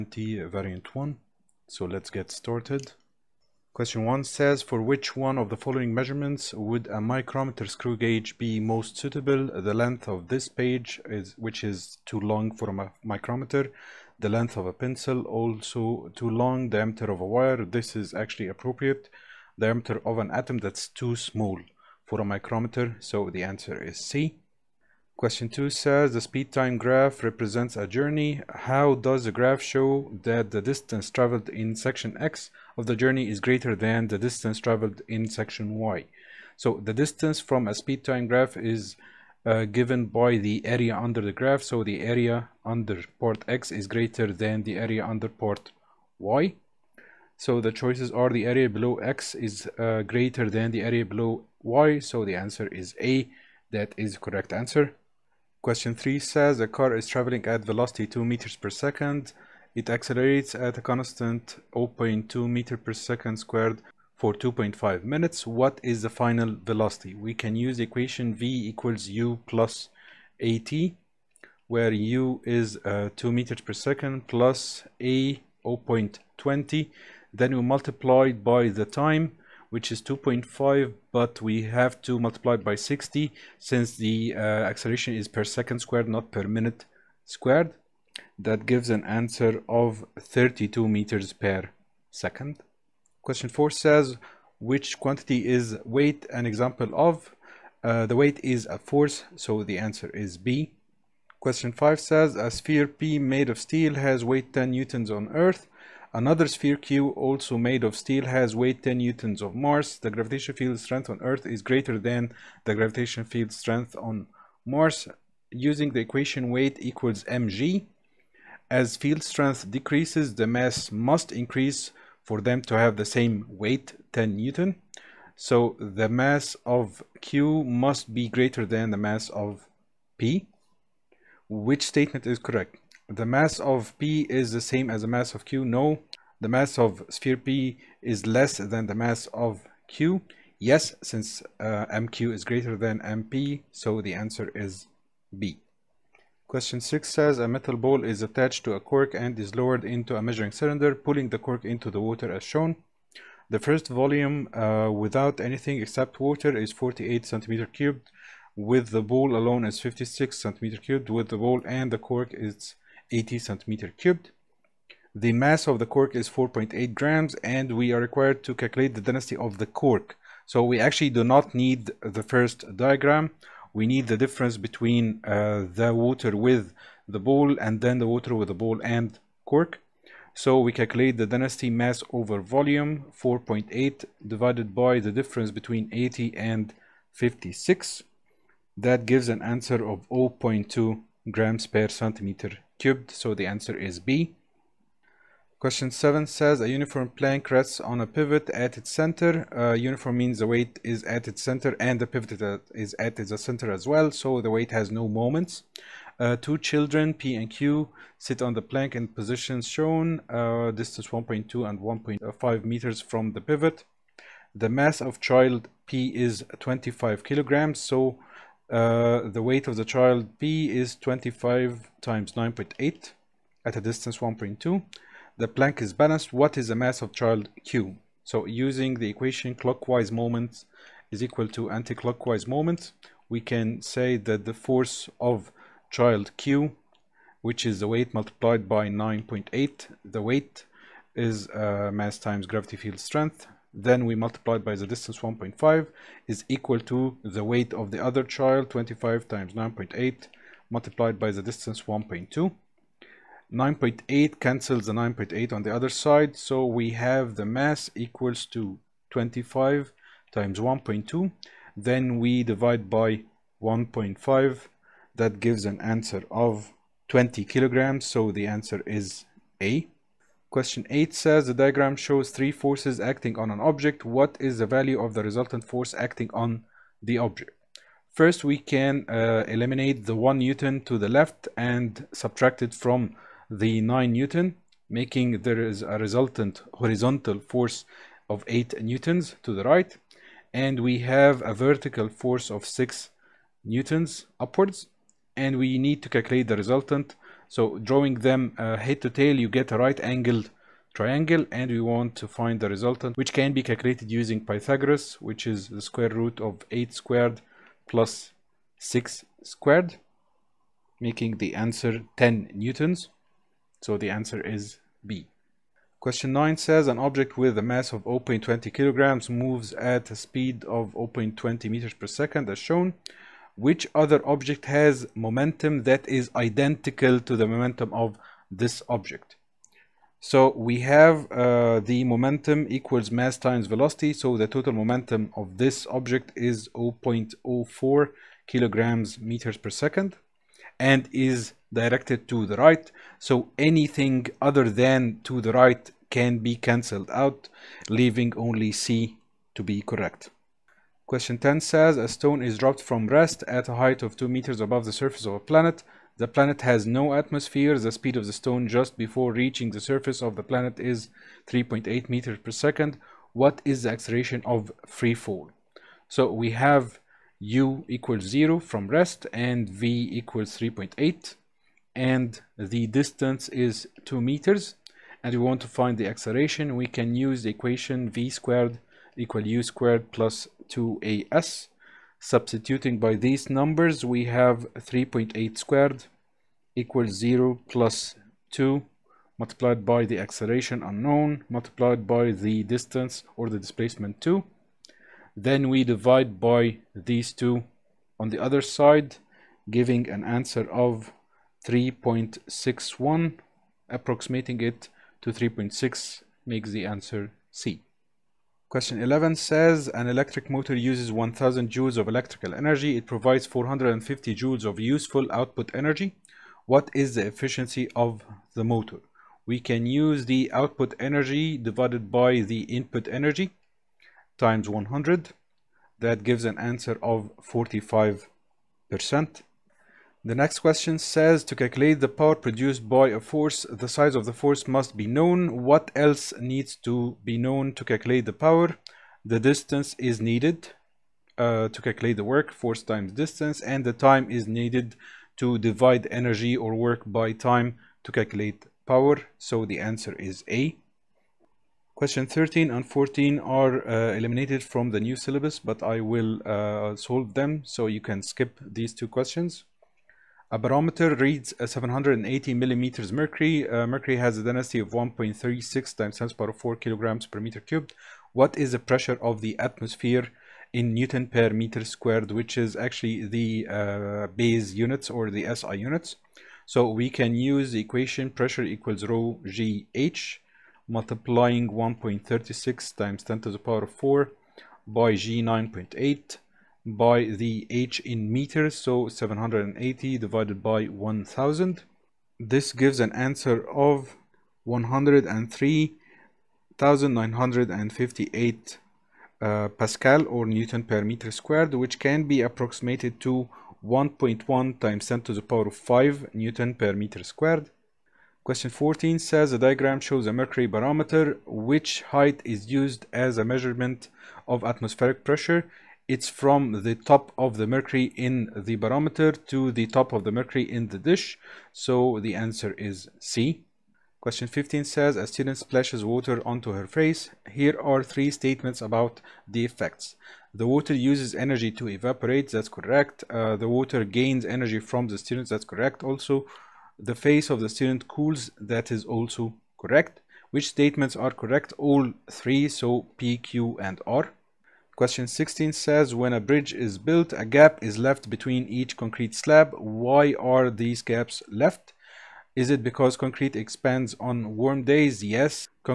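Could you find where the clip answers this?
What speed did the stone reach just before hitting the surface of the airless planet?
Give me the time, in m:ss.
6:01.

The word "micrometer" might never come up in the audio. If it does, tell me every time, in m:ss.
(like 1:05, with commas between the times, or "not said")
0:07, 0:13, 0:22.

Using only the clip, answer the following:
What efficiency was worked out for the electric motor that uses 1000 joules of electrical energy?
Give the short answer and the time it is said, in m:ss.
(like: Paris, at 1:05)
45 percent, at 7:07.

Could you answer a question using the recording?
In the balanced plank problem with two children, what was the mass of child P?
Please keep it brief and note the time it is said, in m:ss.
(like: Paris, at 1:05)
25 kilograms, at 3:36.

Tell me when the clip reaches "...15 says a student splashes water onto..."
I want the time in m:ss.
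8:44.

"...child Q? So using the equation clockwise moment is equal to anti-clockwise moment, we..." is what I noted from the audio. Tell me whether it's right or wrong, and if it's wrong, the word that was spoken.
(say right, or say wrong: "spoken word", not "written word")
right.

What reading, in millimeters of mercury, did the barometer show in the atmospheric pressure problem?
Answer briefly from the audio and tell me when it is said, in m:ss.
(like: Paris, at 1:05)
780 millimeters mercury, at 7:41.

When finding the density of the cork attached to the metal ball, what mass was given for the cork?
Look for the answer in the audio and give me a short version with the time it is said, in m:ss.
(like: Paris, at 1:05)
4.8 grams, at 2:46.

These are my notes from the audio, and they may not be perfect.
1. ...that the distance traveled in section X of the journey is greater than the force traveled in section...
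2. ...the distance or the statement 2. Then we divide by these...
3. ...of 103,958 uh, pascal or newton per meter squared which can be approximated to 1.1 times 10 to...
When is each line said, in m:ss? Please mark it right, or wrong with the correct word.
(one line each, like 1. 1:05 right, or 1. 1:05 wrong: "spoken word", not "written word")
1. 0:30 wrong: "distance", not "force"
2. 6:32 wrong: "displacement", not "statement"
3. 8:13 right.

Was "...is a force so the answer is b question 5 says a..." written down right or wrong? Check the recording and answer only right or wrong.
right.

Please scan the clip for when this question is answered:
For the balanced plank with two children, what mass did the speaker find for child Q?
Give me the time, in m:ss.
4:27.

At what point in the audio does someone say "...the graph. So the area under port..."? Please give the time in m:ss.
0:41.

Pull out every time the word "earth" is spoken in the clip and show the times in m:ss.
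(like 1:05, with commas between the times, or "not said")
1:45, 1:51.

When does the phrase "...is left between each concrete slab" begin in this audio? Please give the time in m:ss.
9:07.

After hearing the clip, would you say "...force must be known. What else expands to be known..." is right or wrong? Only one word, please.
wrong.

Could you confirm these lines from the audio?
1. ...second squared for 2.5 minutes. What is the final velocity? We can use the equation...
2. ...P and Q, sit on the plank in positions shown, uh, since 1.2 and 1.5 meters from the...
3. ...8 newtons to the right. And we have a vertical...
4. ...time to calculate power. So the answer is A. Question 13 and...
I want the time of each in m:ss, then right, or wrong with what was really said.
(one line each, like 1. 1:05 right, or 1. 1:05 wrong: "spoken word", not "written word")
1. 1:02 right
2. 3:27 wrong: "distance", not "since"
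3. 4:48 right
4. 7:27 right.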